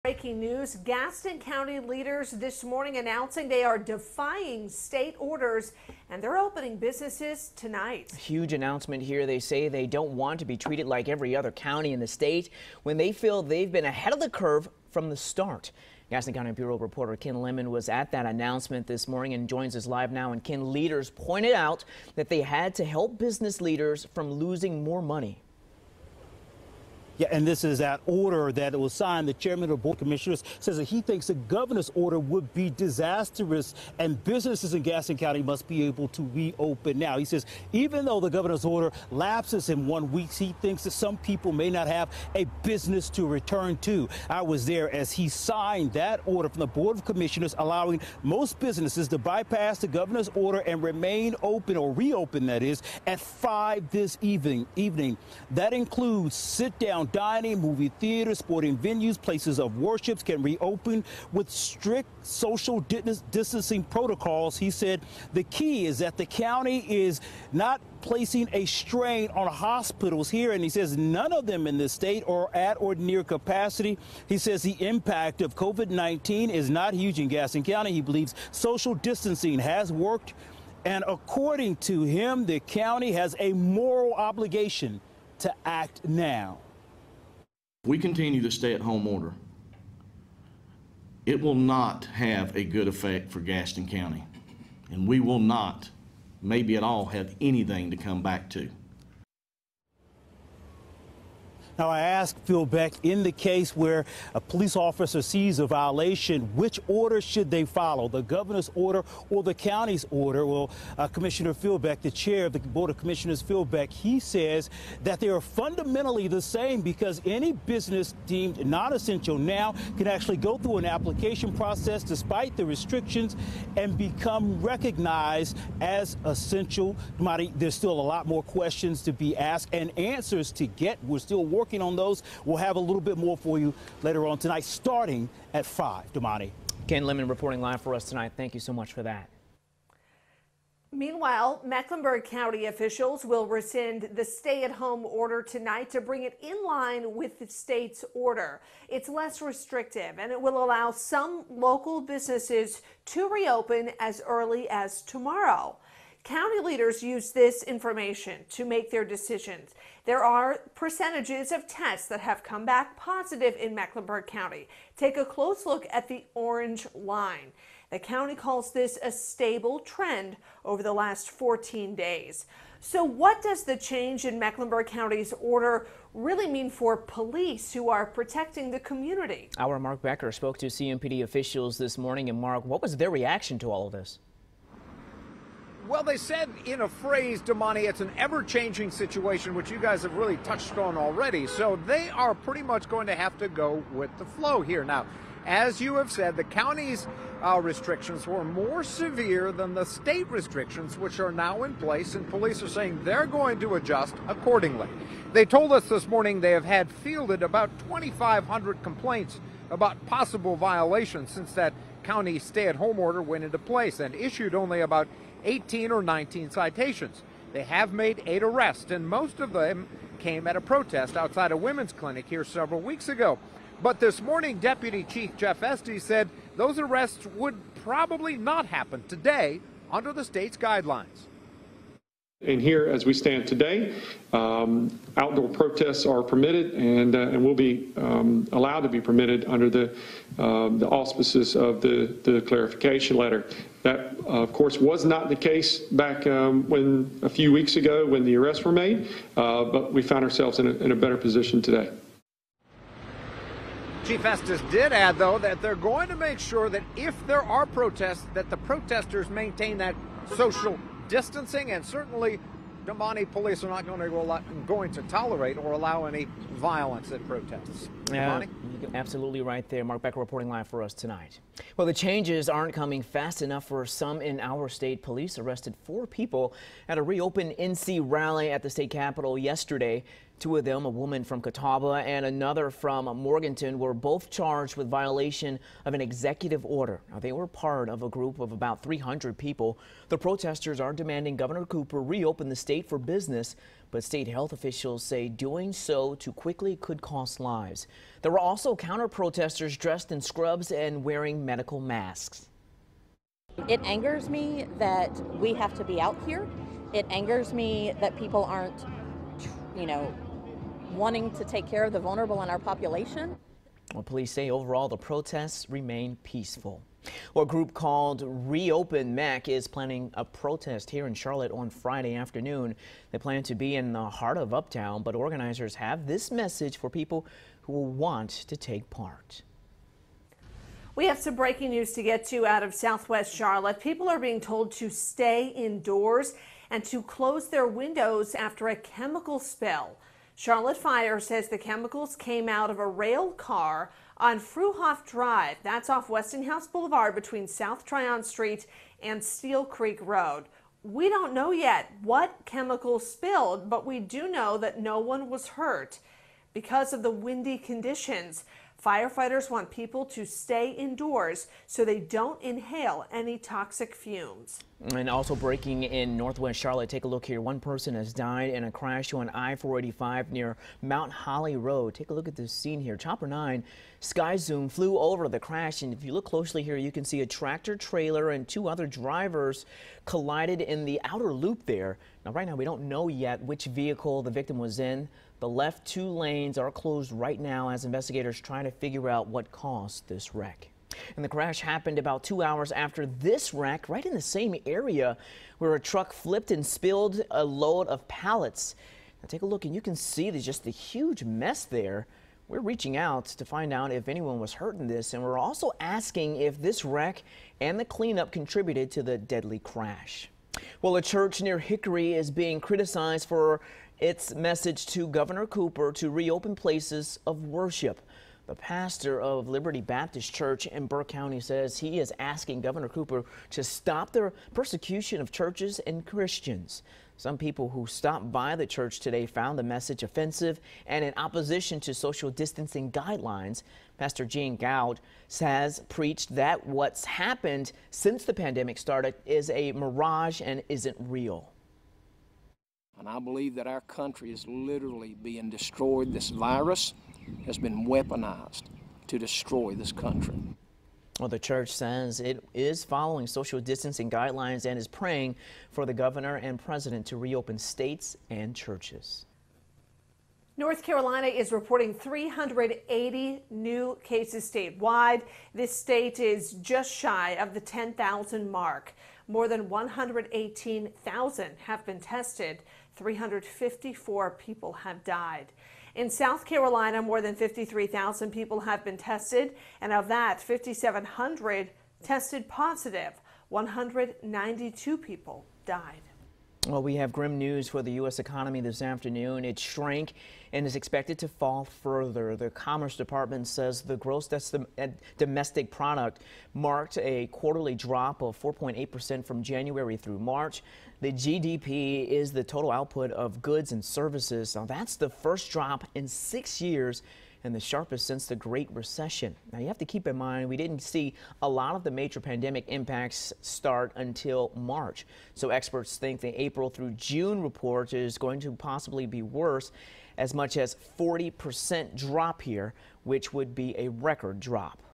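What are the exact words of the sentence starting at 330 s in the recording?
We have some breaking news to get to out of Southwest Charlotte.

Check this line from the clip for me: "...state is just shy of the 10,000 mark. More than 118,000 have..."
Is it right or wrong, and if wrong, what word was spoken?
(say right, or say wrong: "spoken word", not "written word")
right.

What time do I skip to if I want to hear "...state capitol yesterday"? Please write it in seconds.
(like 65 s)
278 s.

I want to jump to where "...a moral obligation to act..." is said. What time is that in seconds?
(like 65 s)
83 s.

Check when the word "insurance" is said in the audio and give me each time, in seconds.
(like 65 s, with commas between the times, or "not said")
not said.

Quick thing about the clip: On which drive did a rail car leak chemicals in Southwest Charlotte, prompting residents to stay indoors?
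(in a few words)
Fruhoff Drive.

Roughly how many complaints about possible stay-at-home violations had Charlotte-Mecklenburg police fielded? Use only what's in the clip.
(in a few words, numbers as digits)
2,500.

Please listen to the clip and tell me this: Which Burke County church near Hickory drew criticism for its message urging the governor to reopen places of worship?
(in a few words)
Liberty Baptist Church.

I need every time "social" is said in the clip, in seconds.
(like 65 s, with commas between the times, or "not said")
62 s, 78 s, 260 s, 431 s, 453 s.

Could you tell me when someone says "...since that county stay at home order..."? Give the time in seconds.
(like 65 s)
211 s.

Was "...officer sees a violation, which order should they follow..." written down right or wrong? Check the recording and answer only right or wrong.
right.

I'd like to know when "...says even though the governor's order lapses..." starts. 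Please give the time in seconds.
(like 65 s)
37 s.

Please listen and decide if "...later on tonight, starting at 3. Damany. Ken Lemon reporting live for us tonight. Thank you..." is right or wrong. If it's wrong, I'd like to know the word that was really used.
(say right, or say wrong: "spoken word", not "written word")
wrong: "5", not "3".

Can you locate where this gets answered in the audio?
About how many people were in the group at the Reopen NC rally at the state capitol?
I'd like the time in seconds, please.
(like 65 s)
288 s.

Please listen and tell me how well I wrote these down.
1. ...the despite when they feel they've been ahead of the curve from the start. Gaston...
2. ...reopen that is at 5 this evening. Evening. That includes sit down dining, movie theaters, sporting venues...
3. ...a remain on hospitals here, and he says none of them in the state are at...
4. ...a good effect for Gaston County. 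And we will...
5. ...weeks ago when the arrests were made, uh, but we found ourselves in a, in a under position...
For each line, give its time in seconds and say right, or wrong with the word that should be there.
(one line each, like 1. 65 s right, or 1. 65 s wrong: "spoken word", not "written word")
1. 11 s wrong: "state", not "despite"
2. 51 s right
3. 68 s wrong: "strain", not "remain"
4. 92 s right
5. 247 s wrong: "better", not "under".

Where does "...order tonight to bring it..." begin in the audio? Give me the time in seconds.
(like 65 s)
145 s.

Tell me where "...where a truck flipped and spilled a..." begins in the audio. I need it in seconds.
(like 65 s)
395 s.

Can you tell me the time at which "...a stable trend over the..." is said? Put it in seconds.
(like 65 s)
169 s.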